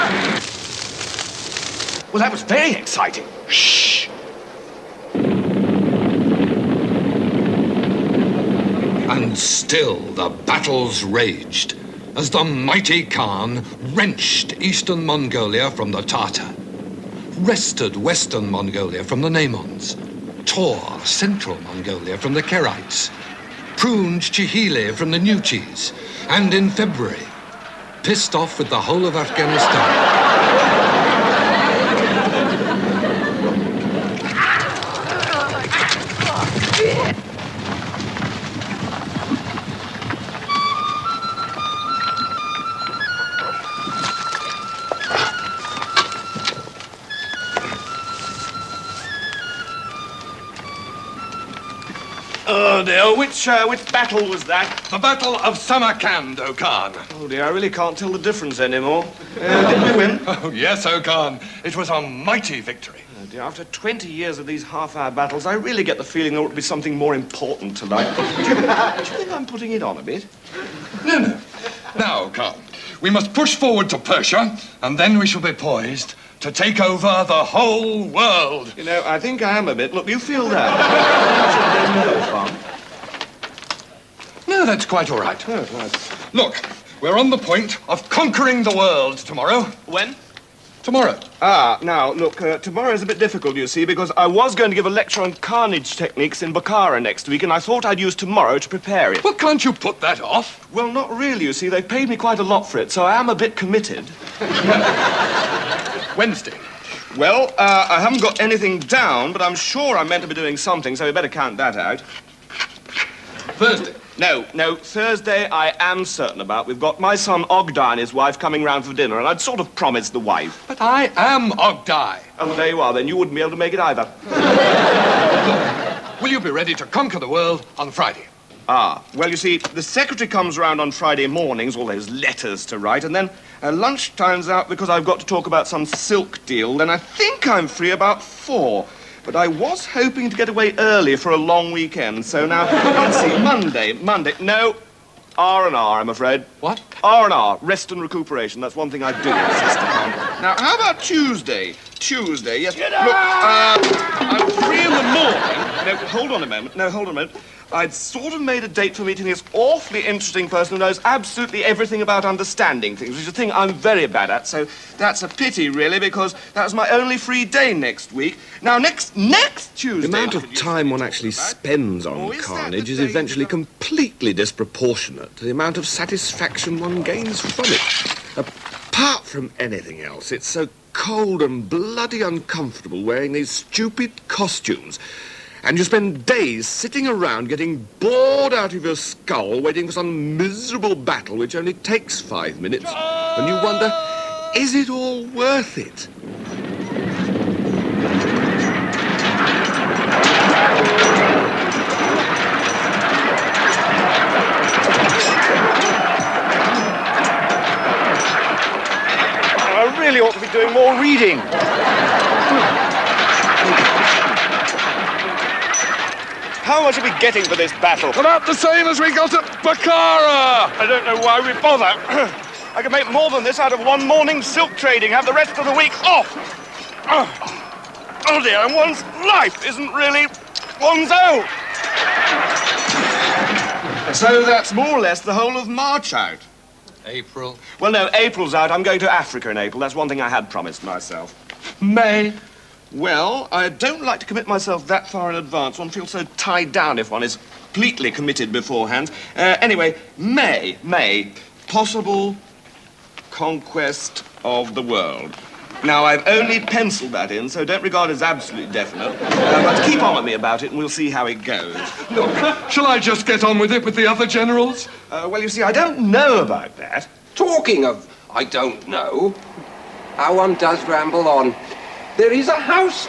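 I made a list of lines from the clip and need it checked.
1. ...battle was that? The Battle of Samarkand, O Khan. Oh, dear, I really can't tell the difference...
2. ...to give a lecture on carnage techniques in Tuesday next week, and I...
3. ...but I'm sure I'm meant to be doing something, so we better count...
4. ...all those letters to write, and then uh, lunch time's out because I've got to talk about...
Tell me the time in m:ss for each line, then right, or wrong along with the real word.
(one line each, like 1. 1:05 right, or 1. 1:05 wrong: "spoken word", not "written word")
1. 0:53 right
2. 1:34 wrong: "Bokhara", not "Tuesday"
3. 1:49 right
4. 2:11 right.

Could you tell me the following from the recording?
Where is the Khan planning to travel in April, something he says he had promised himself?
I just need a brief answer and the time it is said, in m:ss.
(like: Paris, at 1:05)
Africa, at 3:59.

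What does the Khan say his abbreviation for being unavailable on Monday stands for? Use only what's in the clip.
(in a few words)
Rest and recuperation.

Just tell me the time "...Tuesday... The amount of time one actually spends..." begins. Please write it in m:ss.
2:49.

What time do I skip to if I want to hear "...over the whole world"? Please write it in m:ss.
1:16.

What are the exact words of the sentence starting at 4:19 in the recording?
Uh, but keep on with me about it, and we'll see how it goes.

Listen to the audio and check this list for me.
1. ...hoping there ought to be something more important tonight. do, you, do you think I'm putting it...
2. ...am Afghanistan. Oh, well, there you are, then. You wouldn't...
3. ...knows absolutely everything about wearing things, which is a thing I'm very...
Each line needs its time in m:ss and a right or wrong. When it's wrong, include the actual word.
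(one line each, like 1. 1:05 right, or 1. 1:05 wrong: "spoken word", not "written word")
1. 1:06 wrong: "feeling", not "hoping"
2. 2:01 wrong: "Ogdai", not "Afghanistan"
3. 2:40 wrong: "understanding", not "wearing".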